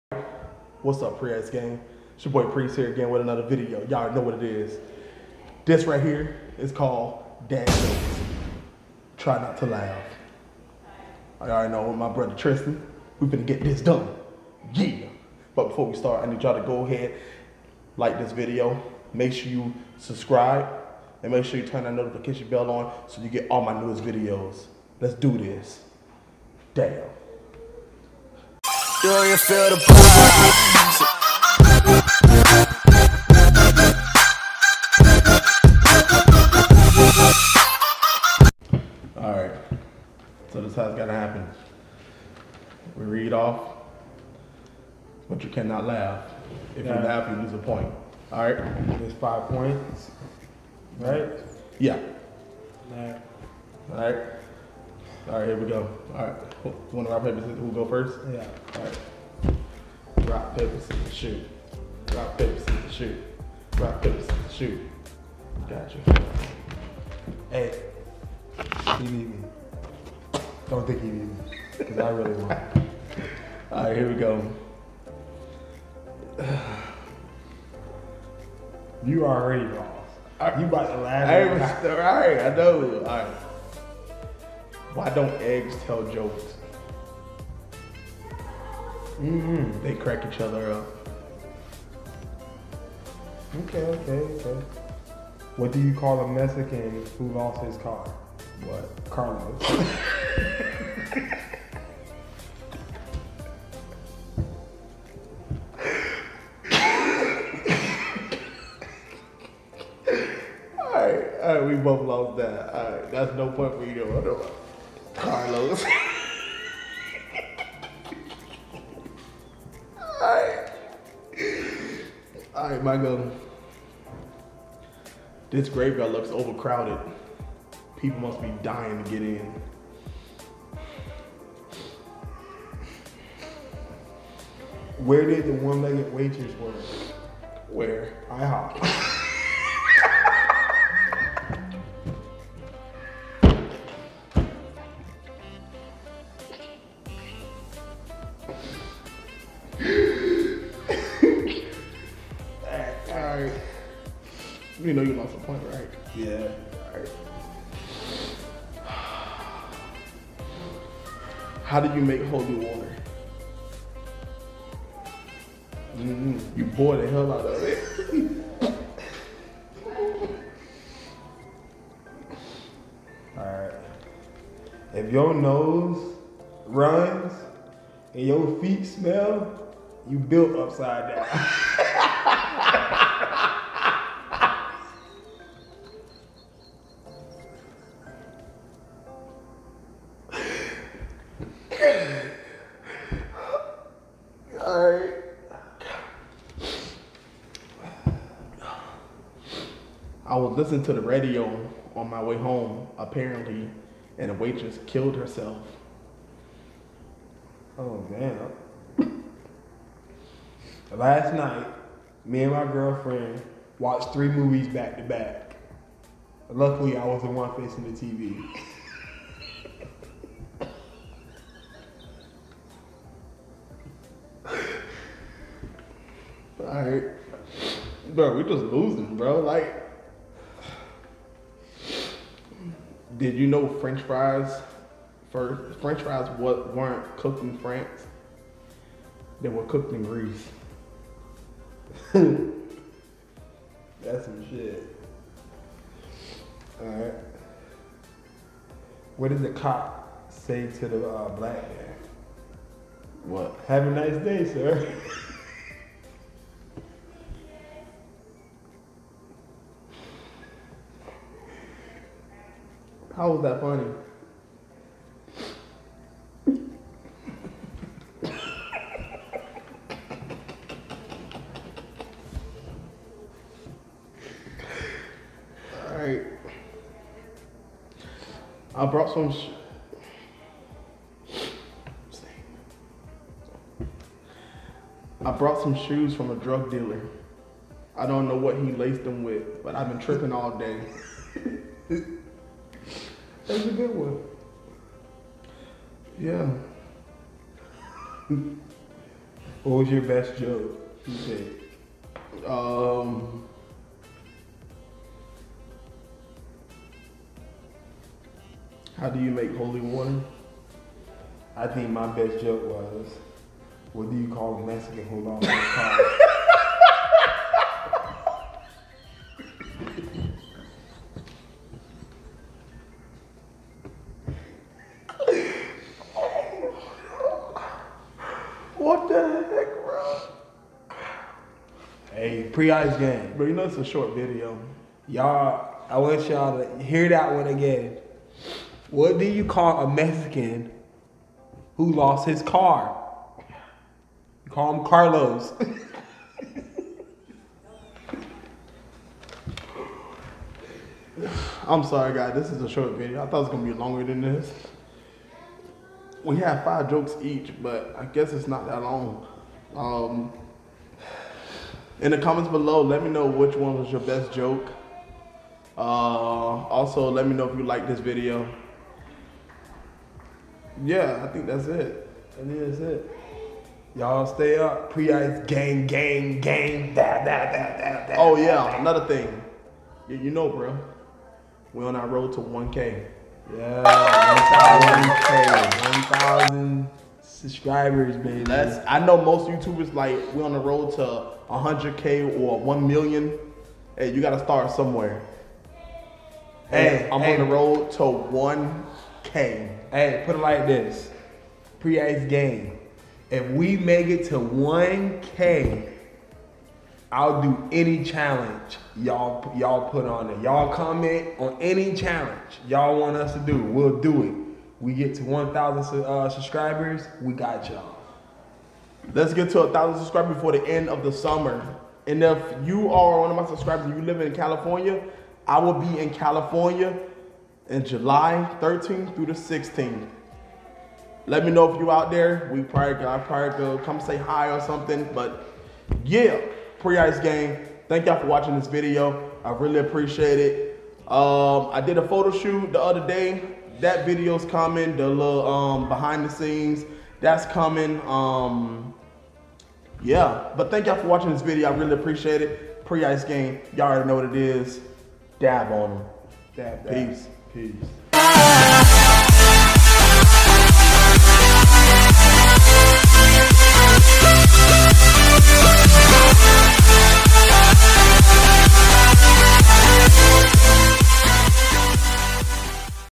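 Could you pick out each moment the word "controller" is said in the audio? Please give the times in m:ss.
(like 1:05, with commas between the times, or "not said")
not said.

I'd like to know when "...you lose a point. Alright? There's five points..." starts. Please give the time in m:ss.
0:47.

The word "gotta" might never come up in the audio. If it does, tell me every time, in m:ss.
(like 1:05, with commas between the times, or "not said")
0:40, 6:34.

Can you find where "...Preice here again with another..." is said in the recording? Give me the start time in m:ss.
0:02.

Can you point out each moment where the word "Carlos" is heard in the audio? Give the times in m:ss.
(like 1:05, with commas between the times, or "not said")
1:39, 1:55, 5:44.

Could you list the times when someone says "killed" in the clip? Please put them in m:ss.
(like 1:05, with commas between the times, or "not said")
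3:24.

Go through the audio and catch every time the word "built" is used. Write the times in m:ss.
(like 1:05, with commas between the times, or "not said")
3:00.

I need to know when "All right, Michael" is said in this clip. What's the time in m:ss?
2:02.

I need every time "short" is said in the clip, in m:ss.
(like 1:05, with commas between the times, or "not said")
5:33, 5:52.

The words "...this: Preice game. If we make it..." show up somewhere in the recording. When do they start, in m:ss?
6:40.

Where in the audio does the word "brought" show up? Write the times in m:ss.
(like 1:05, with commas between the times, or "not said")
4:38, 4:45.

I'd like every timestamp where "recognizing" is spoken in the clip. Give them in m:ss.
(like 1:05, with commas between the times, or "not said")
not said.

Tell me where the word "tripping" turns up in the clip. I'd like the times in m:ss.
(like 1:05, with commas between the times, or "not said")
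4:49.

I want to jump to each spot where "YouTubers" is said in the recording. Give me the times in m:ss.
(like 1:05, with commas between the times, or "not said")
6:29.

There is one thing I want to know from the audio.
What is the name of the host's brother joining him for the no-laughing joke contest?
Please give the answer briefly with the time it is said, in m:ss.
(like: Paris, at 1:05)
Tristan, at 0:12.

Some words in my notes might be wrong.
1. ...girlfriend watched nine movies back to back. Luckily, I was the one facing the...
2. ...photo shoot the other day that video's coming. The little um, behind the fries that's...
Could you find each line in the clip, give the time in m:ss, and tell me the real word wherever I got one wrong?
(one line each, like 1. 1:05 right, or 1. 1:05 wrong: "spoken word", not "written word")
1. 3:32 wrong: "three", not "nine"
2. 7:22 wrong: "scenes", not "fries".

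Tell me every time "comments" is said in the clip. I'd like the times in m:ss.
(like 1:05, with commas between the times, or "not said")
6:02, 6:50.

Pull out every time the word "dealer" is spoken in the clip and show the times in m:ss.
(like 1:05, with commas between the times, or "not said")
4:46.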